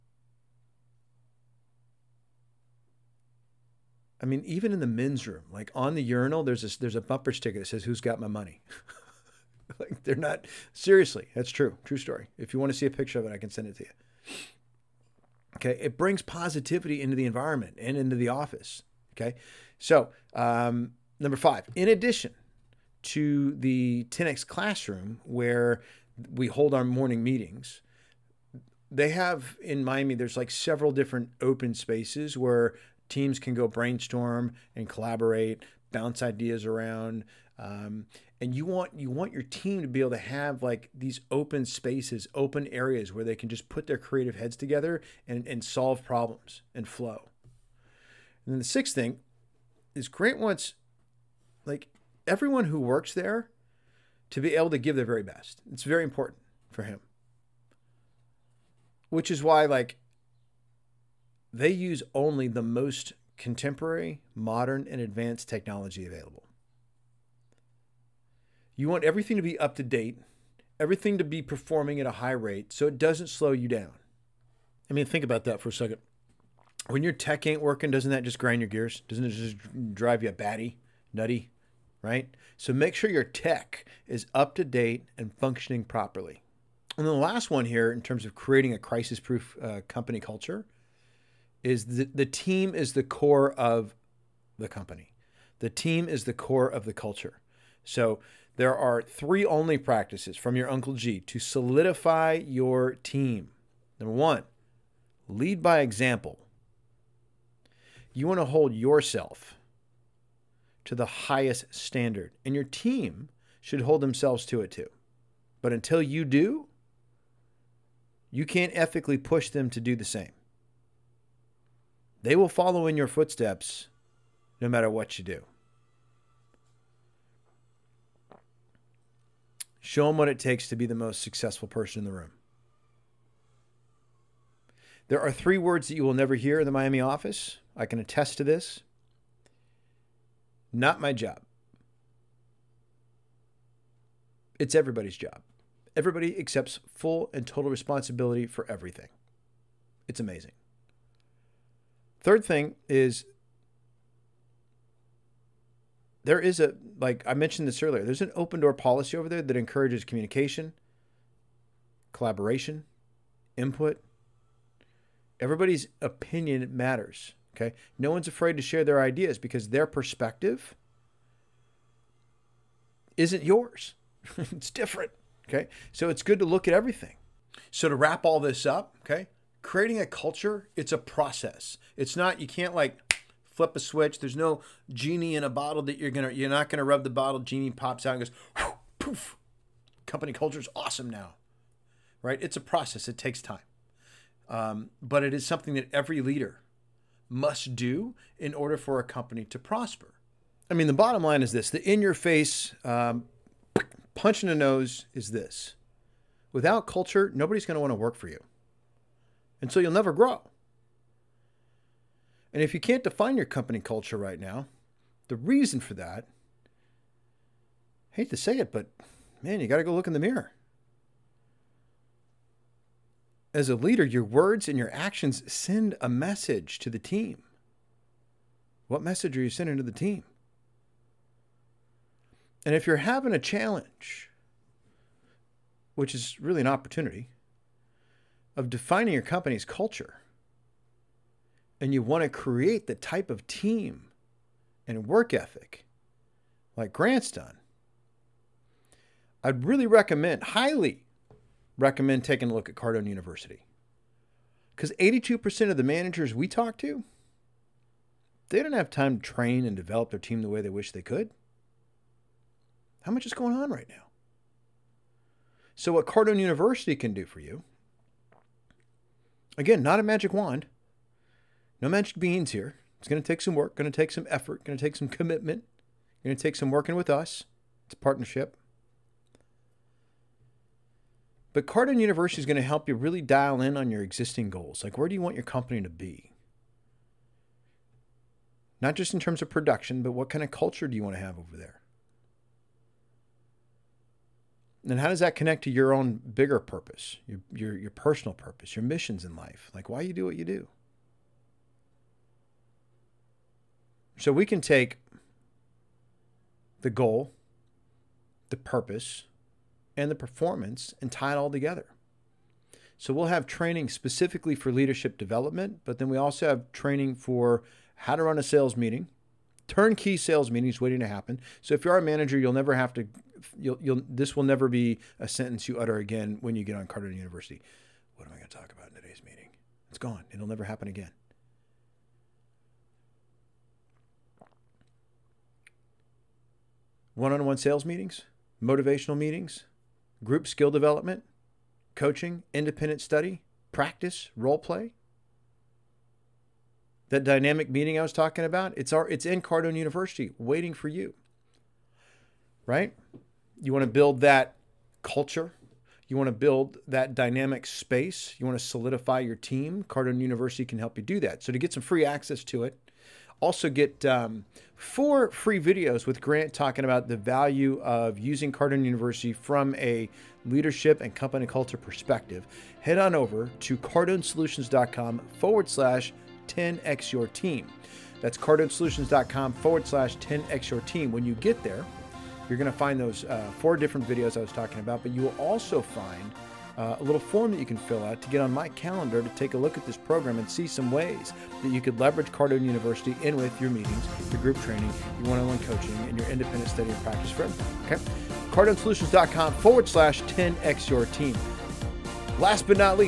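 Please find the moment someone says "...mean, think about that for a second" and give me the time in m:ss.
1:14.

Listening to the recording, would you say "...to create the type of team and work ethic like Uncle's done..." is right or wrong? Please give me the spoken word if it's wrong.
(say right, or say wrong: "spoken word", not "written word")
wrong: "Grant", not "Uncle".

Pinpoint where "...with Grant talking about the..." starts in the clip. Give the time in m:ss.
6:06.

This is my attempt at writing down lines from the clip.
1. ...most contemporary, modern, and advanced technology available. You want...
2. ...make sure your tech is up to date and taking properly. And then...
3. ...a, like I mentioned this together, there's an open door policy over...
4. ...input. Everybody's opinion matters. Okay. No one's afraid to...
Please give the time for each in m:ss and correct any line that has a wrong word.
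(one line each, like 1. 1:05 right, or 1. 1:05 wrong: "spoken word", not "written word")
1. 1:02 right
2. 1:22 wrong: "functioning", not "taking"
3. 2:36 wrong: "earlier", not "together"
4. 2:43 right.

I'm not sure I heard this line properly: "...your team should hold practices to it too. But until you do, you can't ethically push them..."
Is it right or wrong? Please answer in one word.
wrong.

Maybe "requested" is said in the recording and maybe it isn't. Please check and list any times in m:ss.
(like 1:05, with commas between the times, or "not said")
not said.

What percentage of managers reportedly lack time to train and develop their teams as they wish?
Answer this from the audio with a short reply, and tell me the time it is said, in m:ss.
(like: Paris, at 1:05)
82%, at 4:14.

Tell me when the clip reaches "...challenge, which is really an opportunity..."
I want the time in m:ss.
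3:53.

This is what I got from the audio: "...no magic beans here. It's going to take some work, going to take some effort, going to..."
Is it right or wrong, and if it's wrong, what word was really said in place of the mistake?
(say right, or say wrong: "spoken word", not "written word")
right.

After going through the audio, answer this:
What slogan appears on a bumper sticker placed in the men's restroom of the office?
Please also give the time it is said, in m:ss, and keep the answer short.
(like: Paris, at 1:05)
Who's got my money?, at 0:07.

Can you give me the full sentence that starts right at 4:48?
Not just in terms of production, but what kind of culture do you want to have over there?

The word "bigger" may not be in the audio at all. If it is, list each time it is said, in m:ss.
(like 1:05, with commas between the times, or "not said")
4:56.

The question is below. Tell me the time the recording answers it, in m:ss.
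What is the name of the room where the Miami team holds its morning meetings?
0:24.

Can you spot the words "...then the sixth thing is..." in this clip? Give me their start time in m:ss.
0:48.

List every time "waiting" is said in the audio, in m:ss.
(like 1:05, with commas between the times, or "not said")
5:20, 5:50.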